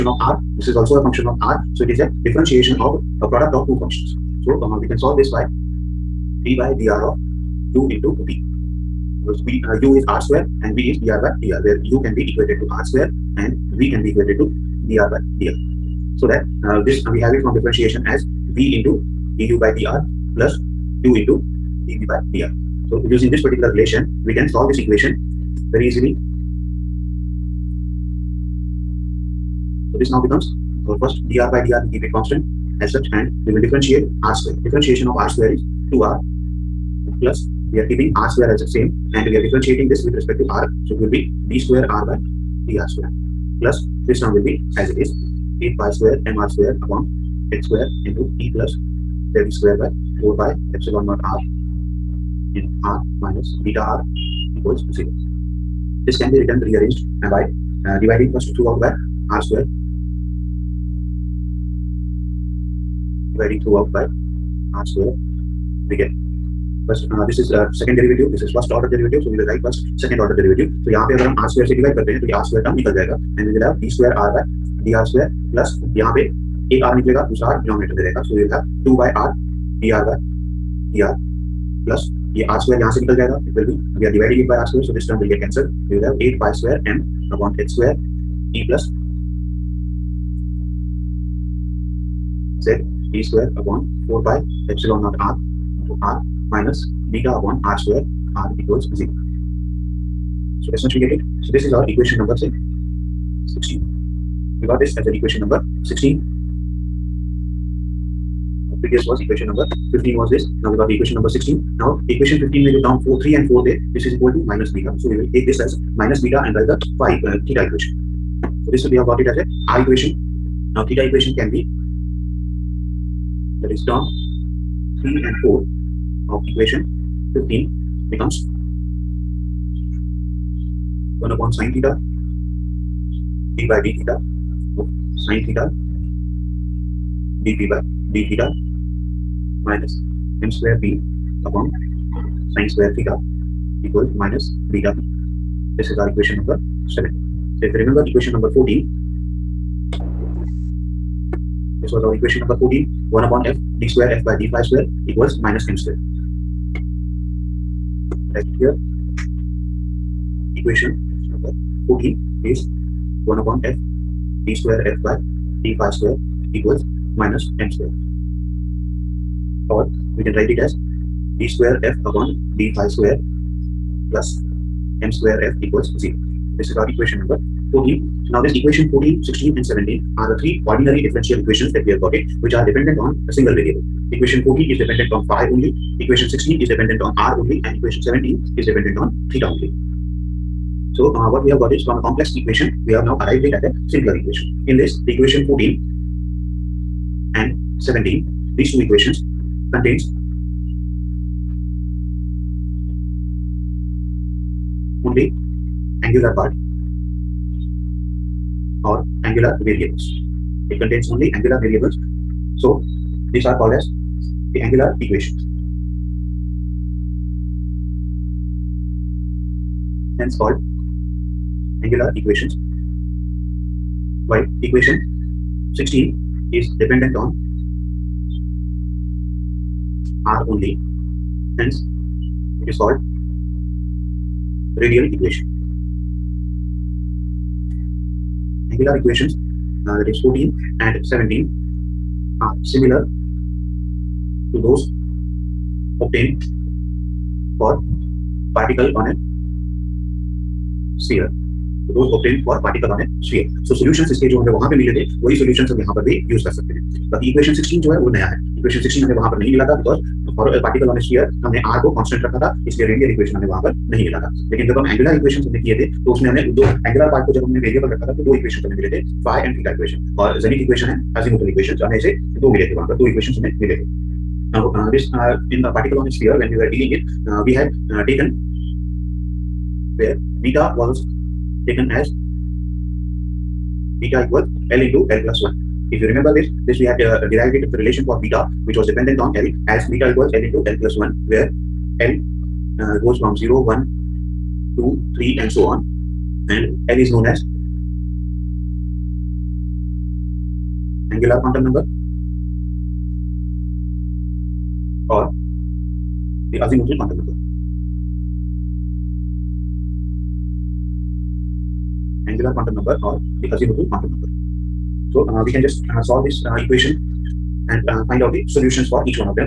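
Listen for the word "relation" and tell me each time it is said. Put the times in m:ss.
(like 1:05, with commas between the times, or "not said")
0:23, 4:47.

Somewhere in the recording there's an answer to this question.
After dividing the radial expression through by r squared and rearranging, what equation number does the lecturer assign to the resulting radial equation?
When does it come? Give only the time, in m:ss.
1:42.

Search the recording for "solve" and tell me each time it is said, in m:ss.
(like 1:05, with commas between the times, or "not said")
0:04, 0:24, 5:16.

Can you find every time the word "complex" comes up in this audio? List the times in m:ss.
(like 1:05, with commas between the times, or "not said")
3:12.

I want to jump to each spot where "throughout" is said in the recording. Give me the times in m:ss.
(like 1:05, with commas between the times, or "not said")
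0:58, 1:03.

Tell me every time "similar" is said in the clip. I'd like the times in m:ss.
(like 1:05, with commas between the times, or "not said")
4:02.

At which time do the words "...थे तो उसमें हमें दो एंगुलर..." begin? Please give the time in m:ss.
4:25.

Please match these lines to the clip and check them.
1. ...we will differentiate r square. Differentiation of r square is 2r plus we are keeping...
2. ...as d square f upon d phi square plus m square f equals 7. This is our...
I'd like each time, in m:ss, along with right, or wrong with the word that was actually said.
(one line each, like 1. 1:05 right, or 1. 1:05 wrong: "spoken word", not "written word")
1. 0:33 right
2. 2:50 wrong: "0", not "7".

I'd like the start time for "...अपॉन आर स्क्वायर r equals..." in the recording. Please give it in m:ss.
1:37.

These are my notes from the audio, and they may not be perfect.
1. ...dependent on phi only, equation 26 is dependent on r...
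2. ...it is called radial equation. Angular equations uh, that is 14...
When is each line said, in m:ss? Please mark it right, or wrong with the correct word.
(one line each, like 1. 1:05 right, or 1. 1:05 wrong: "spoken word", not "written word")
1. 3:04 wrong: "16", not "26"
2. 3:52 right.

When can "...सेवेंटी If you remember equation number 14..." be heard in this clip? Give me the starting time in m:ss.
2:26.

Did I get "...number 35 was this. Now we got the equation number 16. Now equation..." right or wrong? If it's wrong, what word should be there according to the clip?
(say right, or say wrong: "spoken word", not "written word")
wrong: "15", not "35".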